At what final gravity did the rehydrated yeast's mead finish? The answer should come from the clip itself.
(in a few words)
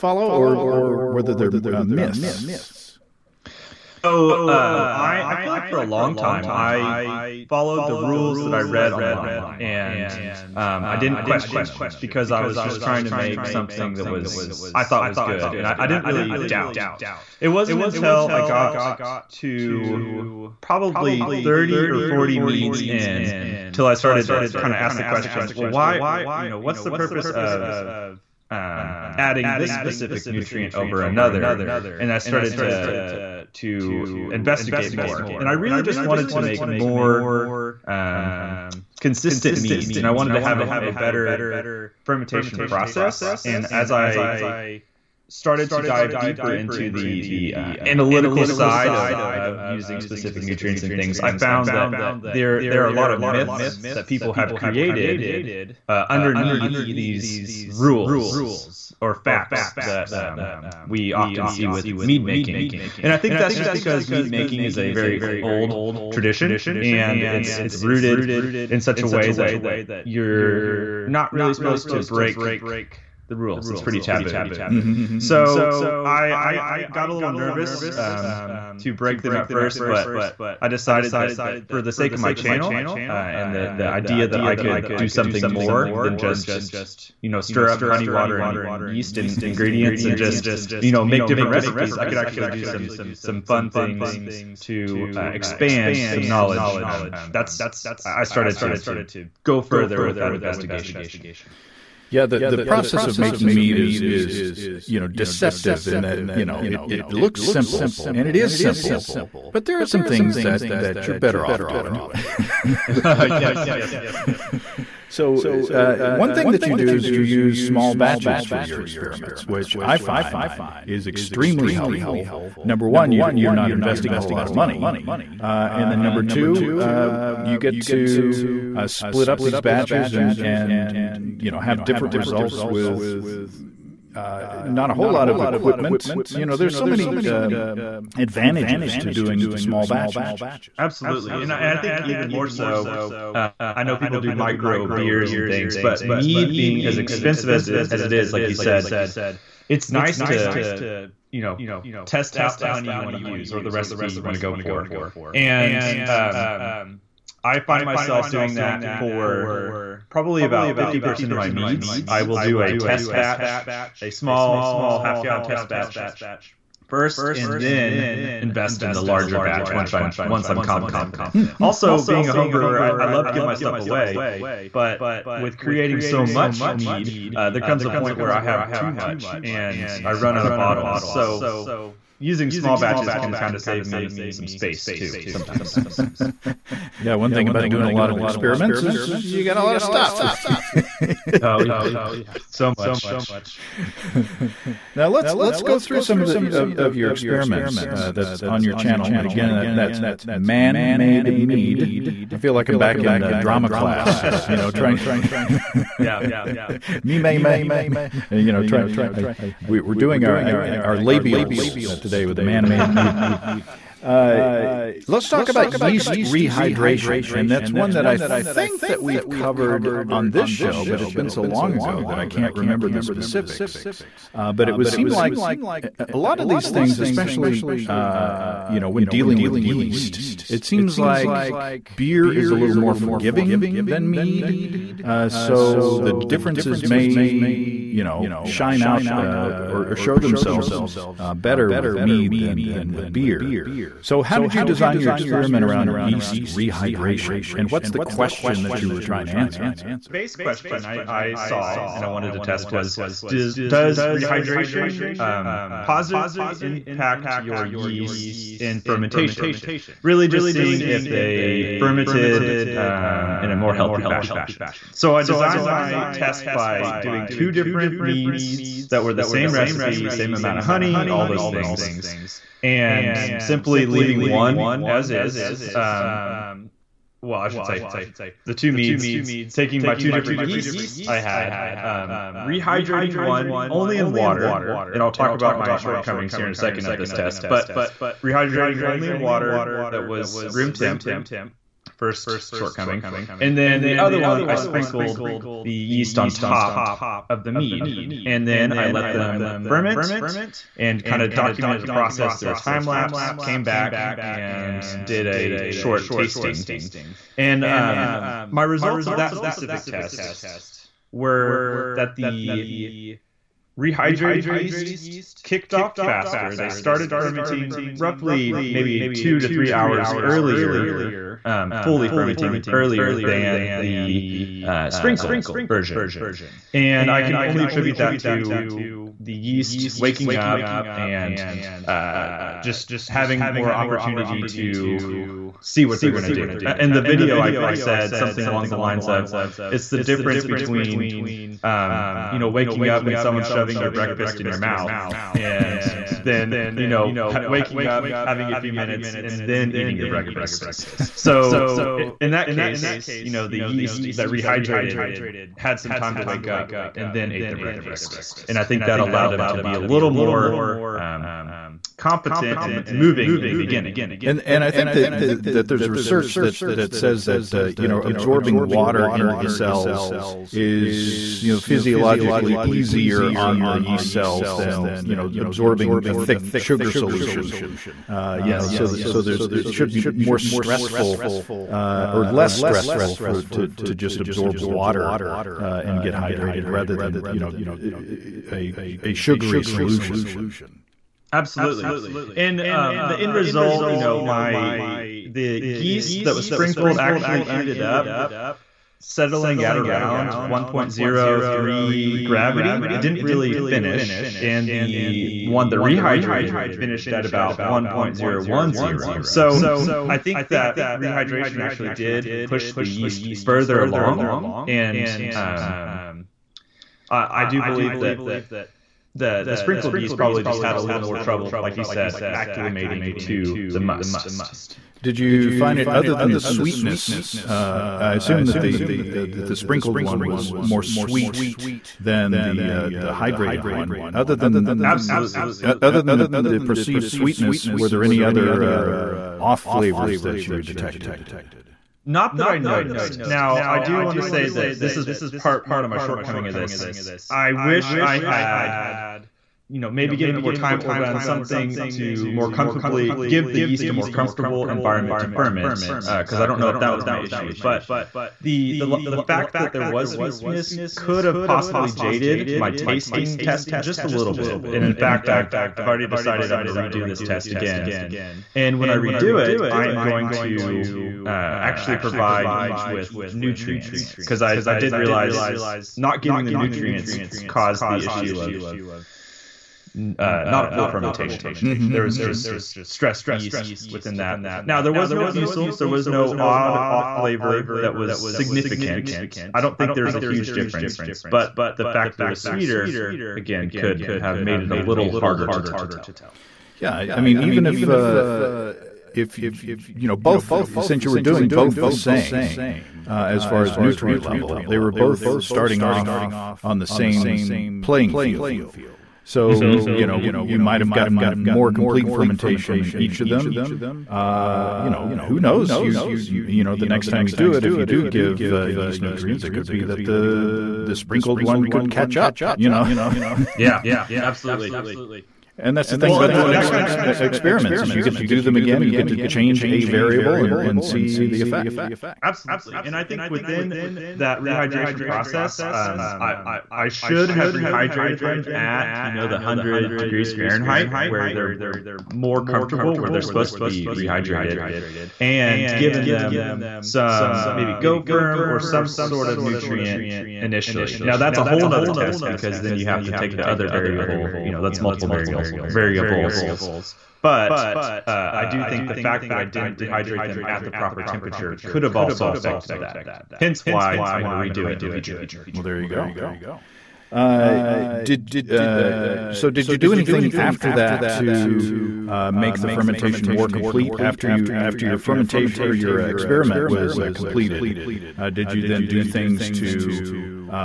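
1.010.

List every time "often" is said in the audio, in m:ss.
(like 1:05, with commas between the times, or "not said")
1:01.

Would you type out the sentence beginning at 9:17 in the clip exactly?
But uh, I do think the fact that I didn't rehydrate them at the proper temperature could have also affected that.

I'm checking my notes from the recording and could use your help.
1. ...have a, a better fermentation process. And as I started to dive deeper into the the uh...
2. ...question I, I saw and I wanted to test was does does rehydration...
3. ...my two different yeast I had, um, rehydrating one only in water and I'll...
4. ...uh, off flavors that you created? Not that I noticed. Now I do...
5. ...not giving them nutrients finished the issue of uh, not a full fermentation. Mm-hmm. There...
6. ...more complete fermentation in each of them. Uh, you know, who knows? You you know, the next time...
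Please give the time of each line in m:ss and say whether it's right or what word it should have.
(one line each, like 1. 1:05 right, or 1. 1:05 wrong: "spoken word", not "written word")
1. 0:40 right
2. 4:10 right
3. 4:39 right
4. 7:18 wrong: "detected", not "created"
5. 7:55 wrong: "caused", not "finished"
6. 8:31 right.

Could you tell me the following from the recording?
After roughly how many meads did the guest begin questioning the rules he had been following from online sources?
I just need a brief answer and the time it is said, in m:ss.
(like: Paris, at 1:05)
30 or 40, at 0:21.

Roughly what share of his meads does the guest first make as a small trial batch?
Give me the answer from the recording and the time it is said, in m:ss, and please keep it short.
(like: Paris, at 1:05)
50%, at 2:40.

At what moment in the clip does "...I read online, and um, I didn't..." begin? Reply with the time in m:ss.
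0:08.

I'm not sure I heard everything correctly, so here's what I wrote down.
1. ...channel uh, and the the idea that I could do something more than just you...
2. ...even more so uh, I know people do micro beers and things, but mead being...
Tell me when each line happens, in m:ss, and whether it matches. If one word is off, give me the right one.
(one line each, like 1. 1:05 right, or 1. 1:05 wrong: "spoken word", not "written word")
1. 1:22 right
2. 2:22 right.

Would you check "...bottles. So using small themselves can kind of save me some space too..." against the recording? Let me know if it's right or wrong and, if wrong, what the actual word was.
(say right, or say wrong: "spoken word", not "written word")
wrong: "batches", not "themselves".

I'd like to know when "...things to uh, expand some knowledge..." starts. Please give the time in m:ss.
1:33.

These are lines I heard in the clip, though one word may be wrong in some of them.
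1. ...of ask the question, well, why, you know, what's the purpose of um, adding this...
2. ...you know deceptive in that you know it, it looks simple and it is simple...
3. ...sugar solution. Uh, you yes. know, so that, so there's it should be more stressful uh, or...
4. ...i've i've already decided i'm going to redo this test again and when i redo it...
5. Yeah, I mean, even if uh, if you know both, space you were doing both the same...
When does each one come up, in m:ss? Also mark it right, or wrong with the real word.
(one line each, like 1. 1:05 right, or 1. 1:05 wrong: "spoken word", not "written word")
1. 0:24 right
2. 1:44 right
3. 6:16 right
4. 7:45 right
5. 8:16 wrong: "since", not "space".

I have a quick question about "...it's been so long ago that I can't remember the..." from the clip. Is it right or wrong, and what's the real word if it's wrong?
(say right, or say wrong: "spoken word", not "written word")
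right.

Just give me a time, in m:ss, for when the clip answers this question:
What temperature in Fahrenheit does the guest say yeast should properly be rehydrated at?
8:59.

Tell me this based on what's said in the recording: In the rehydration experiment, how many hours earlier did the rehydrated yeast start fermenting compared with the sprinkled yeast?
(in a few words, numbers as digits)
2 to 3 hours.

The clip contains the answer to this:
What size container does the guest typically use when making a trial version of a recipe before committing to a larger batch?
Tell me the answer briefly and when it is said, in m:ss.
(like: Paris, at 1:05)
half gallon, at 2:44.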